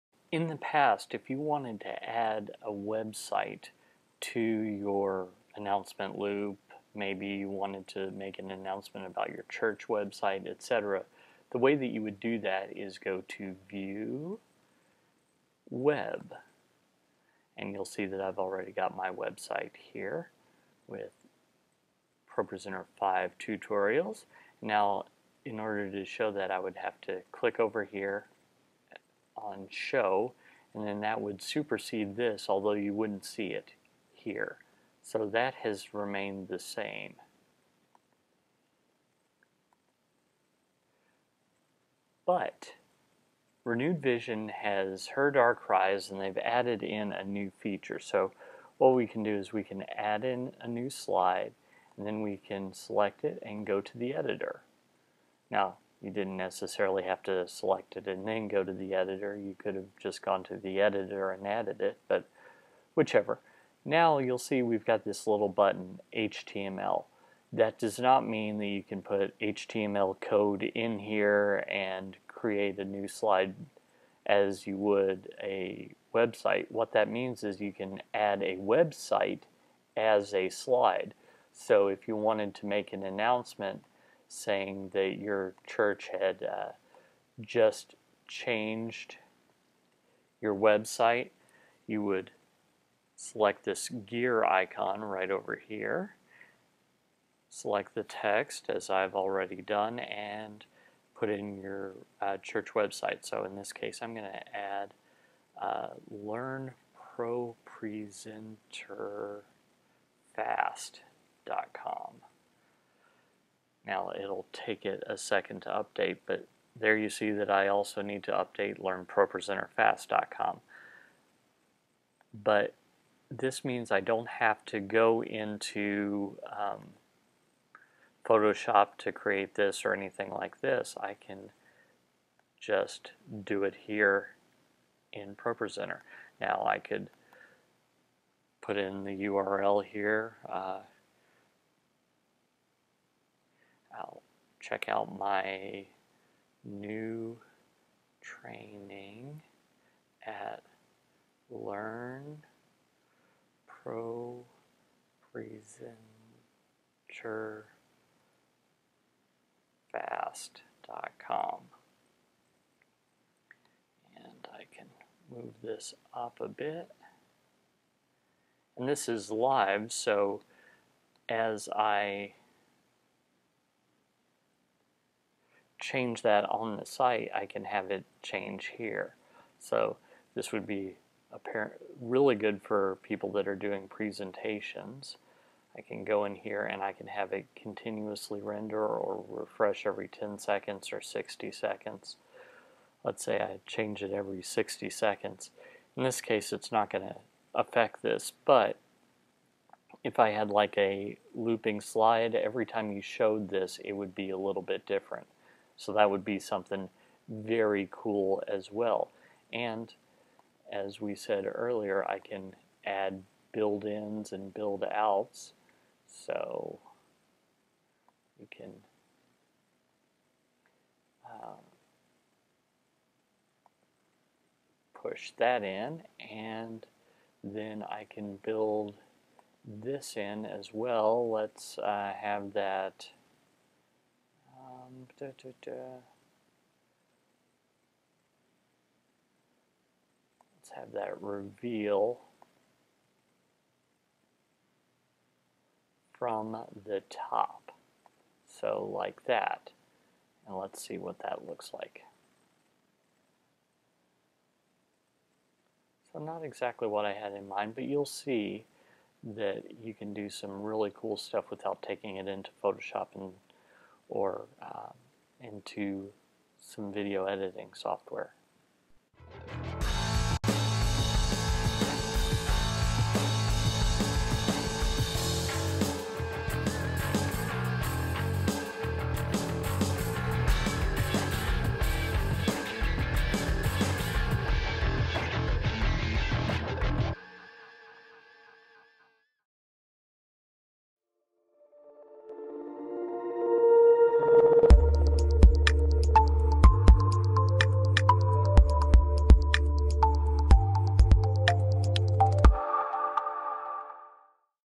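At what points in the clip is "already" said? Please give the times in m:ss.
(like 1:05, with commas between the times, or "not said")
0:18, 1:39.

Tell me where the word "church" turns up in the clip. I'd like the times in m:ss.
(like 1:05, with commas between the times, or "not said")
0:09, 1:25, 1:42.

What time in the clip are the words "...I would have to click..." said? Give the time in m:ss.
0:26.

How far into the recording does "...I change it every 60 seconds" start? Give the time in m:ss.
3:13.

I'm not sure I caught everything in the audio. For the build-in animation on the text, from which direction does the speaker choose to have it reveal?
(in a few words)
From the top.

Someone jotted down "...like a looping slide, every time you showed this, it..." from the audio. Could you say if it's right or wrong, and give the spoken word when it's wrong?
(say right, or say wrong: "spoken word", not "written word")
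right.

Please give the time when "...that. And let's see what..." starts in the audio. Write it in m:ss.
4:09.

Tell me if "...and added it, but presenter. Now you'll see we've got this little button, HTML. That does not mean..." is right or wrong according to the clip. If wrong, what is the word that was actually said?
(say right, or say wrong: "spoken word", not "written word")
wrong: "whichever", not "presenter".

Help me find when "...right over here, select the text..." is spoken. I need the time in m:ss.
1:35.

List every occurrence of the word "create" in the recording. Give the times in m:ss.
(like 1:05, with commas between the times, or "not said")
1:12, 2:09.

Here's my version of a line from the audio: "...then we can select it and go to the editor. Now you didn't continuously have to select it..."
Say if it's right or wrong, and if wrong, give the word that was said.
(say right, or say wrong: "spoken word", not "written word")
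wrong: "necessarily", not "continuously".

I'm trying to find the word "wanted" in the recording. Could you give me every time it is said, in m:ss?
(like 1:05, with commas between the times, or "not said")
0:01, 0:07, 1:22.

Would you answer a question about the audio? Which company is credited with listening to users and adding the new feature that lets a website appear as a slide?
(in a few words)
Renewed Vision.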